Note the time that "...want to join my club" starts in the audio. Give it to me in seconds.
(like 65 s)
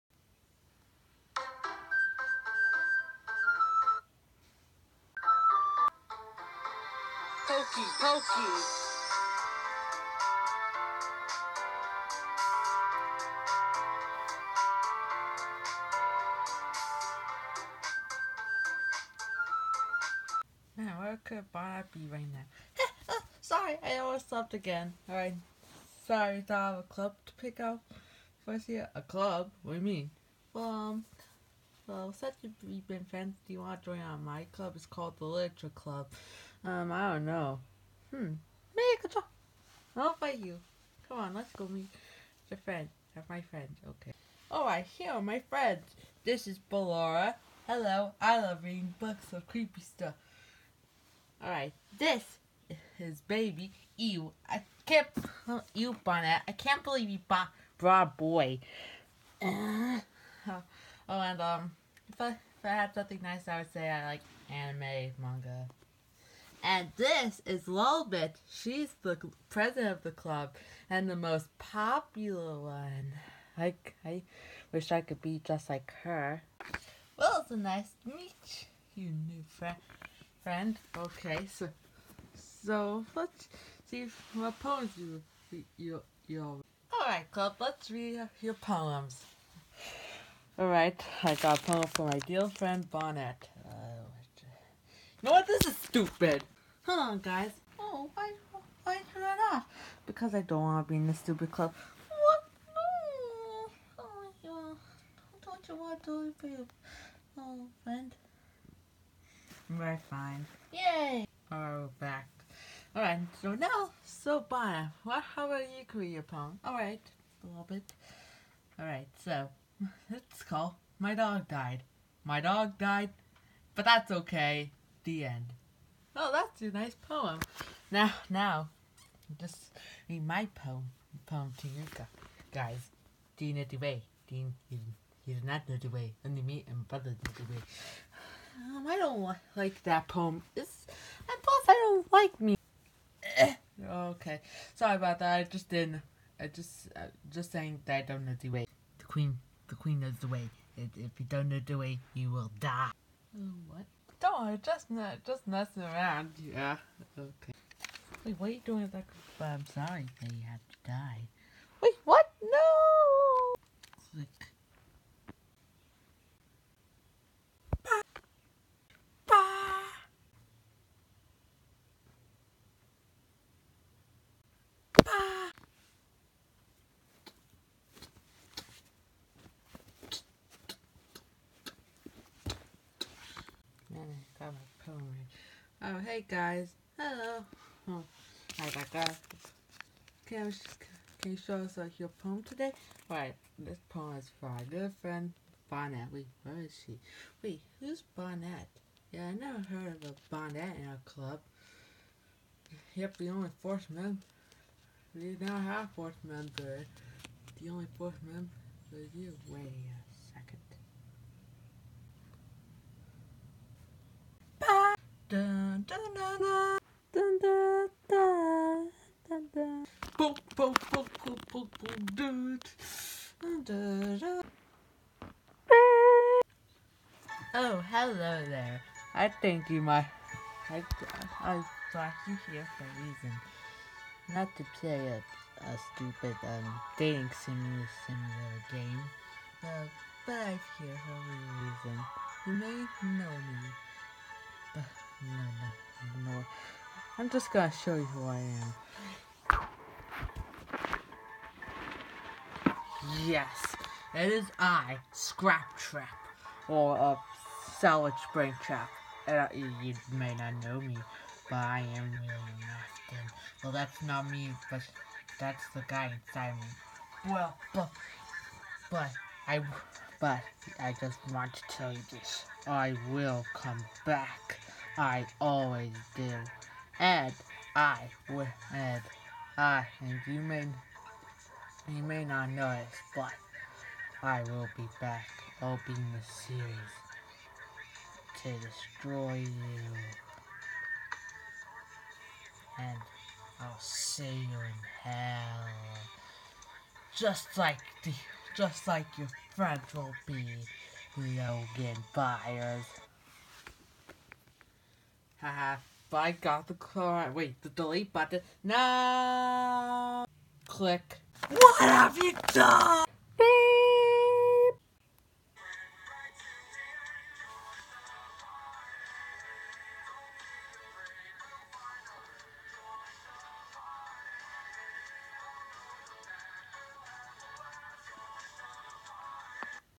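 33 s.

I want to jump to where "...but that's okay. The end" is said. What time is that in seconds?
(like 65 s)
123 s.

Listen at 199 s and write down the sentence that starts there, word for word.
Yeah, I never heard of a Bonnet in our club.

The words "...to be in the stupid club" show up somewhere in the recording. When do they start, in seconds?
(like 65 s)
100 s.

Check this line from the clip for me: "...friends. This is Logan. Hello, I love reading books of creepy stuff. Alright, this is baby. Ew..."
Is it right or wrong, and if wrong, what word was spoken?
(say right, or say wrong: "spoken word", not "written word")
wrong: "Ballora", not "Logan".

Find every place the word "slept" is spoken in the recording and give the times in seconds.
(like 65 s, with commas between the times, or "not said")
24 s.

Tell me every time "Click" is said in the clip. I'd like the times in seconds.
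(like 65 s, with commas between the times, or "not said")
164 s, 310 s.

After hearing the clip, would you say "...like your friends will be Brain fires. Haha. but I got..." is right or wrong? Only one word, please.
wrong.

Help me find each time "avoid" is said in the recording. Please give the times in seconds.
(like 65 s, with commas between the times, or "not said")
not said.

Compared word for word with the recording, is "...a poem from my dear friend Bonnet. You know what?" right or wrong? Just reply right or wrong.
right.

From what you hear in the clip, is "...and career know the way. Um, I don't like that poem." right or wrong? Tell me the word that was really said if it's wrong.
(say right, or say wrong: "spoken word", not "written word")
wrong: "brother", not "career".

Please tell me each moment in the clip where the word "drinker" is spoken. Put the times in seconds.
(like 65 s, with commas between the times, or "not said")
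not said.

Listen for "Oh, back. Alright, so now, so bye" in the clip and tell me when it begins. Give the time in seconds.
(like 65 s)
111 s.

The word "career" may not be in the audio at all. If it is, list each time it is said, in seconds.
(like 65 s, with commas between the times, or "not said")
115 s.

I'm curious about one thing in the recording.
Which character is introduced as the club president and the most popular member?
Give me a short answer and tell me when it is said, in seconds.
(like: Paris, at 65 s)
Lolbit, at 67 s.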